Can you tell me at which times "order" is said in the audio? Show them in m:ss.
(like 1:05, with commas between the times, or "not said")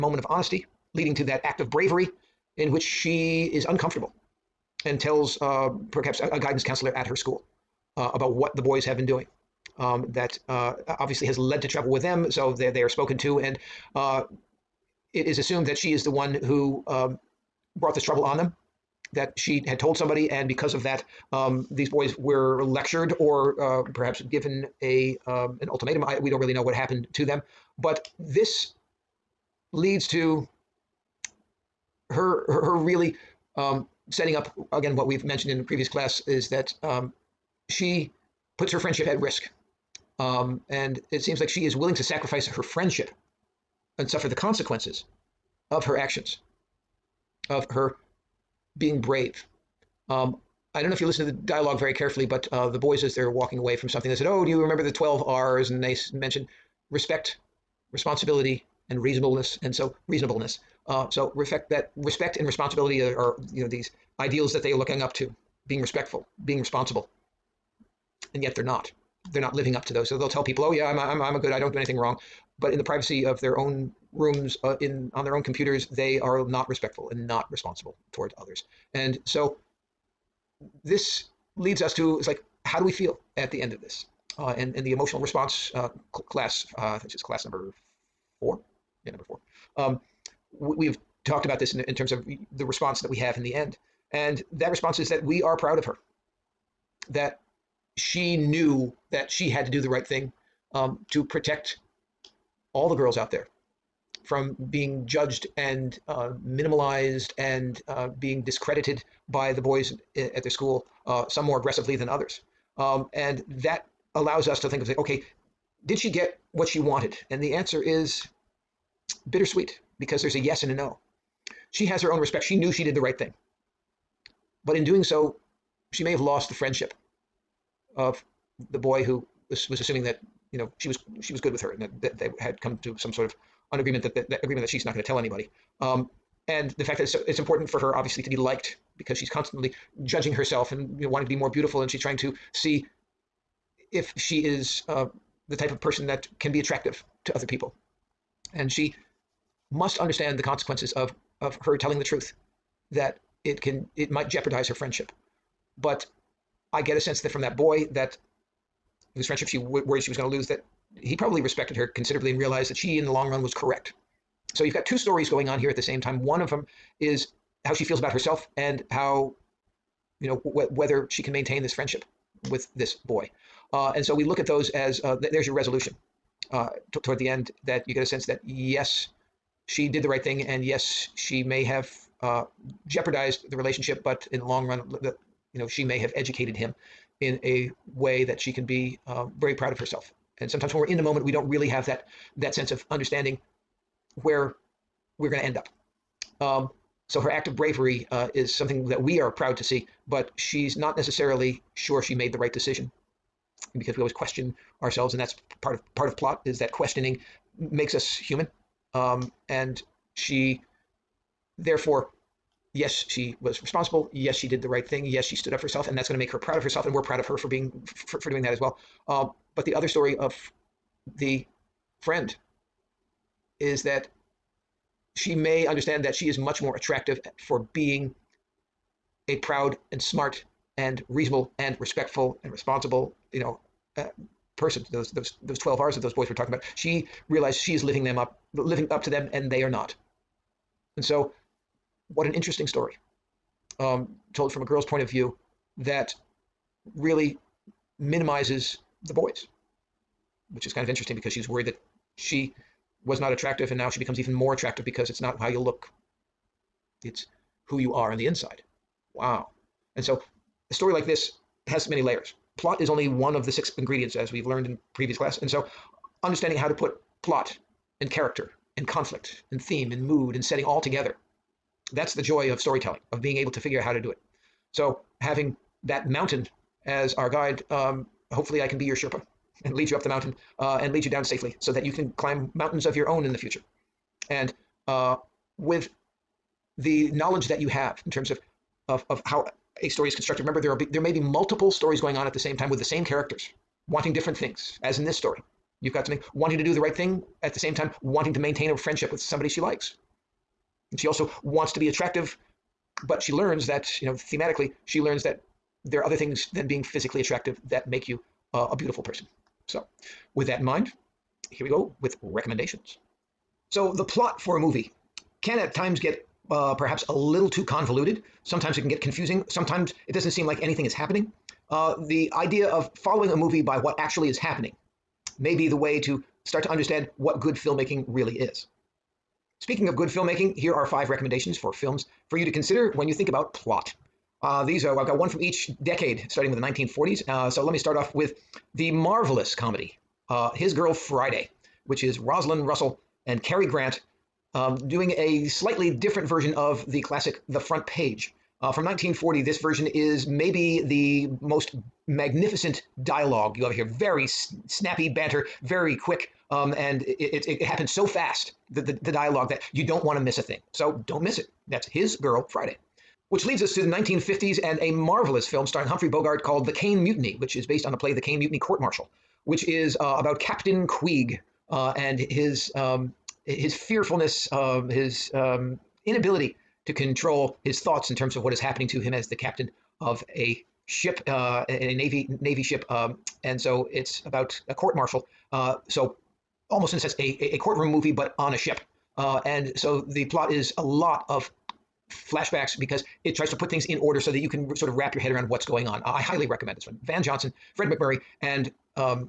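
6:33.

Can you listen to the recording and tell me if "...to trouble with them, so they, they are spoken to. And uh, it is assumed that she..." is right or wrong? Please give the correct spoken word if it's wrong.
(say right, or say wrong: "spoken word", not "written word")
right.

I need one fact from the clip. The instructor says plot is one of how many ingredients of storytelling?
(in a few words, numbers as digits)
6.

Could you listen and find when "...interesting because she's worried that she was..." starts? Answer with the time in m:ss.
4:10.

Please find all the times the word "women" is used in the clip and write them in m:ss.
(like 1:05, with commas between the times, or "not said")
not said.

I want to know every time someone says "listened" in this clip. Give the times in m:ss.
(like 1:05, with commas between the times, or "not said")
0:51.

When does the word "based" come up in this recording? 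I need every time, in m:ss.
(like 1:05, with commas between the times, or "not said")
6:07.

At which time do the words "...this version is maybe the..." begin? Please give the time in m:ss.
5:49.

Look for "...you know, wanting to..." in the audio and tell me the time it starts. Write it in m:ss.
2:21.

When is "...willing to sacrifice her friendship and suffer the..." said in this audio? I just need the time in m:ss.
0:41.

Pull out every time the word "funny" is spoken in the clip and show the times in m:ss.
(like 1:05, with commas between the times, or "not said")
not said.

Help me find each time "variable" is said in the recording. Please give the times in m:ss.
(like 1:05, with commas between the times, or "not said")
not said.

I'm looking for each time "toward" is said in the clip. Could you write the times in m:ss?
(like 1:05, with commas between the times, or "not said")
1:18, 2:57.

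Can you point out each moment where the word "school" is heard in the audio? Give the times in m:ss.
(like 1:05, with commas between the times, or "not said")
0:07, 1:50.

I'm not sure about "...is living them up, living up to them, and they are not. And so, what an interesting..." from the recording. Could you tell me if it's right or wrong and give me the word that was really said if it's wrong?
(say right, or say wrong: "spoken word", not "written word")
right.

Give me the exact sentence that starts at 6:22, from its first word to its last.
Um, and so it's about a court martial.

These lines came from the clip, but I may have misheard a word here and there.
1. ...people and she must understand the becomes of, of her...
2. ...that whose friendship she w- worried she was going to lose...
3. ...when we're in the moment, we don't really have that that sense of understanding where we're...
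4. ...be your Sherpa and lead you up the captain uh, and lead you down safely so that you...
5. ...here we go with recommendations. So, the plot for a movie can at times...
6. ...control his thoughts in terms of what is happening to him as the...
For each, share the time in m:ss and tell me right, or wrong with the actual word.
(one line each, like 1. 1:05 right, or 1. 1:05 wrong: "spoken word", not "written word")
1. 2:27 wrong: "consequences", not "becomes"
2. 2:37 right
3. 3:10 right
4. 4:38 wrong: "mountain", not "captain"
5. 5:11 right
6. 6:16 right.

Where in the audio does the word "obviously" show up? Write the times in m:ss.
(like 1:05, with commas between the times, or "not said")
0:10, 2:17.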